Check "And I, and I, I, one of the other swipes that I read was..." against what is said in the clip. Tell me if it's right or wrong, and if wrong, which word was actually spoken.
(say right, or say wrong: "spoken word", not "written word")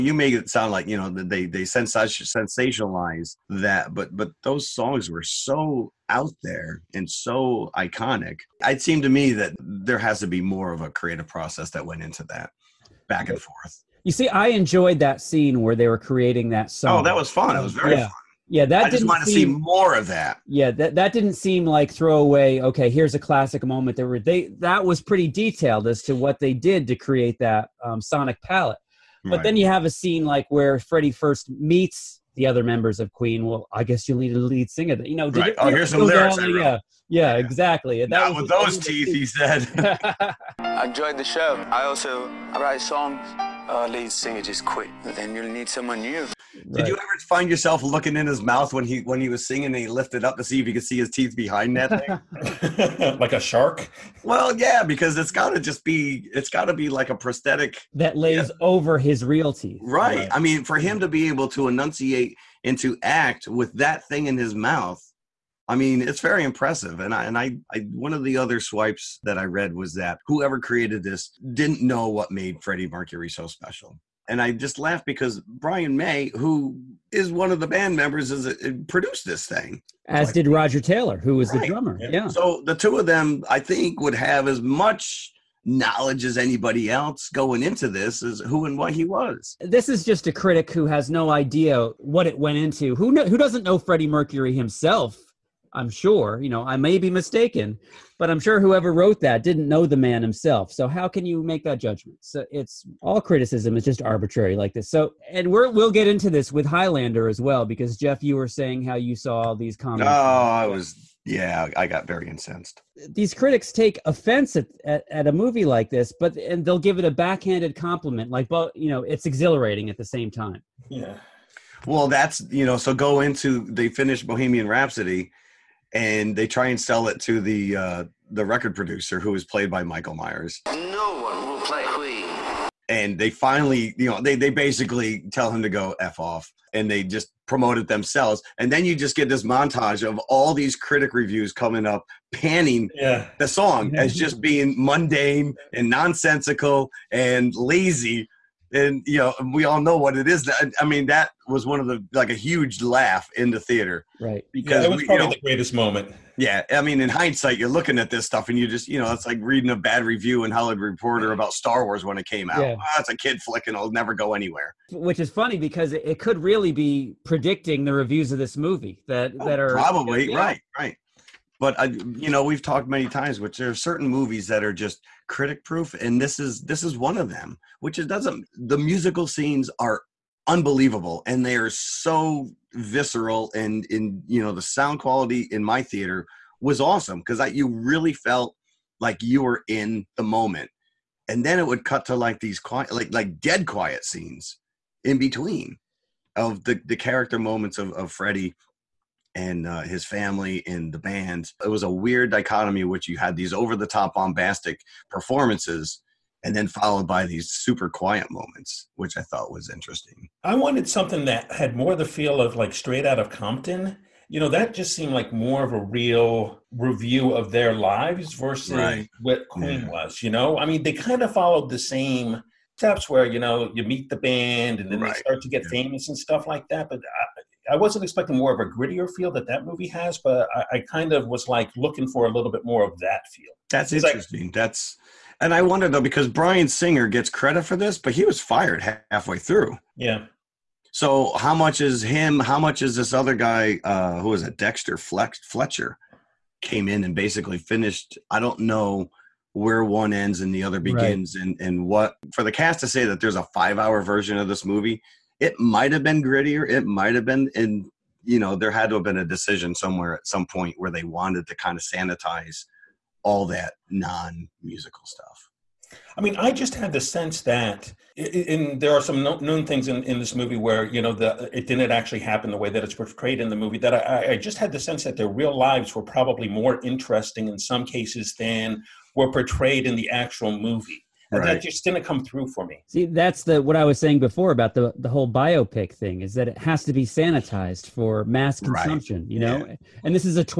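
right.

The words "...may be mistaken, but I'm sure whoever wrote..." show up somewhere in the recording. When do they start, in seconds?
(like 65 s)
96 s.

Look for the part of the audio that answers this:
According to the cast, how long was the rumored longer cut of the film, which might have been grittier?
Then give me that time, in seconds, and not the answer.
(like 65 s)
253 s.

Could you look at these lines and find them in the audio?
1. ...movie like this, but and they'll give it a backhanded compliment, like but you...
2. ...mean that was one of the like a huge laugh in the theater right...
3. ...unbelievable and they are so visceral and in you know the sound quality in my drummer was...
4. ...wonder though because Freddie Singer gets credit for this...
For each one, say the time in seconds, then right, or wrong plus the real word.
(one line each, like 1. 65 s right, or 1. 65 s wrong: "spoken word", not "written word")
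1. 115 s right
2. 150 s right
3. 180 s wrong: "theater", not "drummer"
4. 235 s wrong: "Bryan", not "Freddie".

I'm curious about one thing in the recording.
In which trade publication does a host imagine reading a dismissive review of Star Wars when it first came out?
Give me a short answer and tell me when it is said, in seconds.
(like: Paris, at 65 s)
Hollywood Reporter, at 160 s.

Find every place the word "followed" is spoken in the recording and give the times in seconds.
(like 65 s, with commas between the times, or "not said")
206 s, 221 s.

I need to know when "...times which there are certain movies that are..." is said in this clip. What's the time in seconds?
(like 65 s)
173 s.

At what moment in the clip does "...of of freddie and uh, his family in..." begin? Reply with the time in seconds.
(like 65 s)
197 s.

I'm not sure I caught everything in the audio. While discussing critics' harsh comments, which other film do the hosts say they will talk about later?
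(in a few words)
Highlander.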